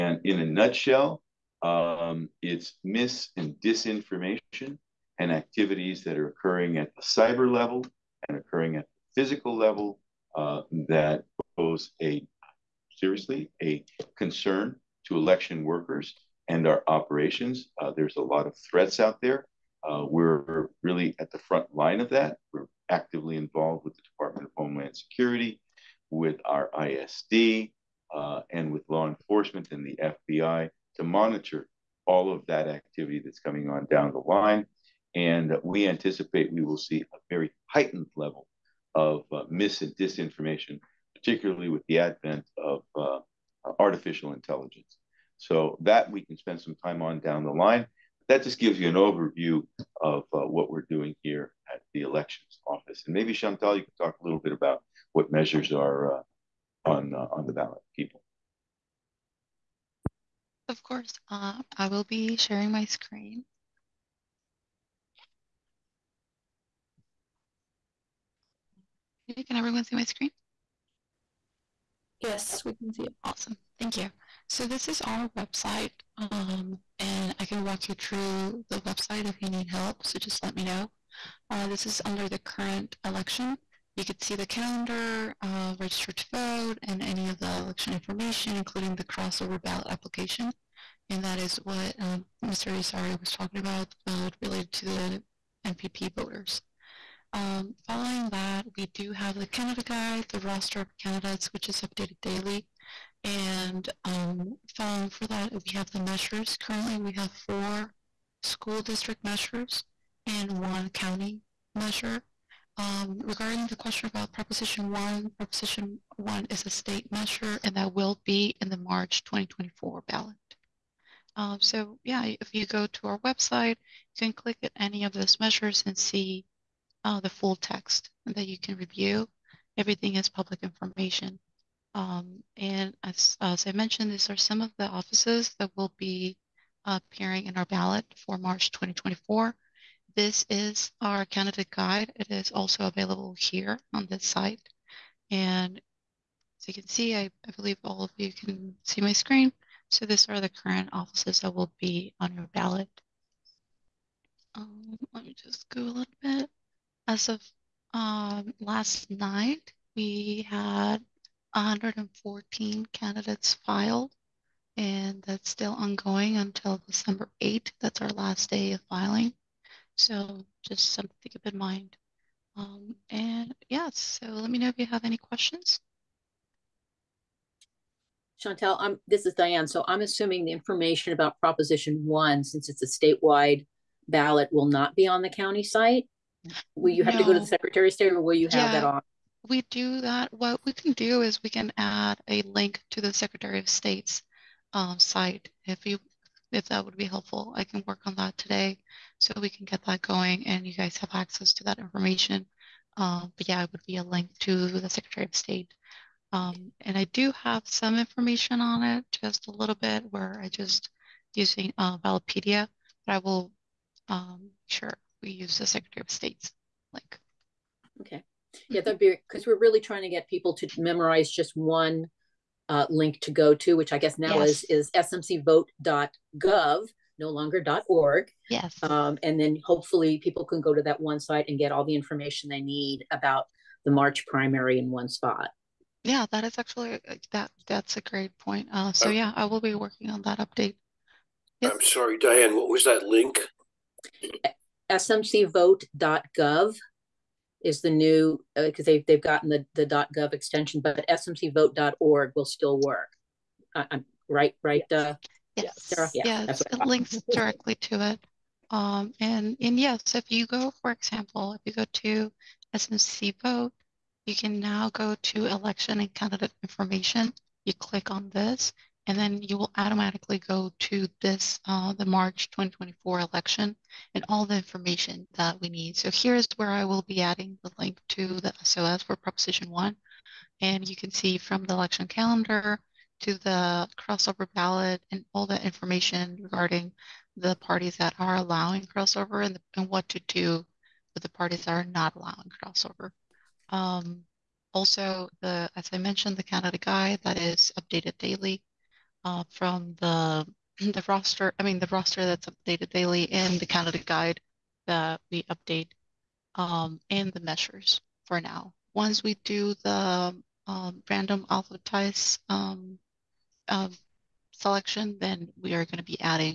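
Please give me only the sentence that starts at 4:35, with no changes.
So here's where I will be adding the link to the SOS for Proposition 1.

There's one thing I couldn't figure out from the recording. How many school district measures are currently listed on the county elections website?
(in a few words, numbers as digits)
4.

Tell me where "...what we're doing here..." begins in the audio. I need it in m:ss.
0:50.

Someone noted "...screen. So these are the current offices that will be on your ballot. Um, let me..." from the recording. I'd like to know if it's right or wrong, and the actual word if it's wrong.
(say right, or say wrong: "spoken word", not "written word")
right.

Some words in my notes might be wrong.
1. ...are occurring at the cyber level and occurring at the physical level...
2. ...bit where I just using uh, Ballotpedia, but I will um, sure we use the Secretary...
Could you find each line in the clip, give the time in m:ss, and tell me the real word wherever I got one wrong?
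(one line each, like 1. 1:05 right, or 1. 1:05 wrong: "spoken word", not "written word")
1. 0:06 right
2. 3:29 right.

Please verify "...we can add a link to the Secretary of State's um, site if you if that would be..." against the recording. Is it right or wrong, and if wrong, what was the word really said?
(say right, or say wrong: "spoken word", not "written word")
right.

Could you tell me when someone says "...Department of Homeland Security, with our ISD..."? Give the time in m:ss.
0:24.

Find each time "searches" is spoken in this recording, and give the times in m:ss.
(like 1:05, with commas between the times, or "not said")
not said.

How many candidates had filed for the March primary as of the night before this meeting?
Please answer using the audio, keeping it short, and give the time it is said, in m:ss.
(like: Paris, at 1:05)
114, at 2:41.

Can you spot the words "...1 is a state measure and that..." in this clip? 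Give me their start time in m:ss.
1:56.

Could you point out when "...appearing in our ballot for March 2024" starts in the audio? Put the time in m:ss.
2:16.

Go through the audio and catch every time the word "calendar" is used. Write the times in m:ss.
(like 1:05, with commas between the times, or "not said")
1:24, 4:42.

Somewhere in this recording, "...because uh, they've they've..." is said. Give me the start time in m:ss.
4:08.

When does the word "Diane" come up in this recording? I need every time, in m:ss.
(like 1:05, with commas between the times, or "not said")
2:59, 4:02.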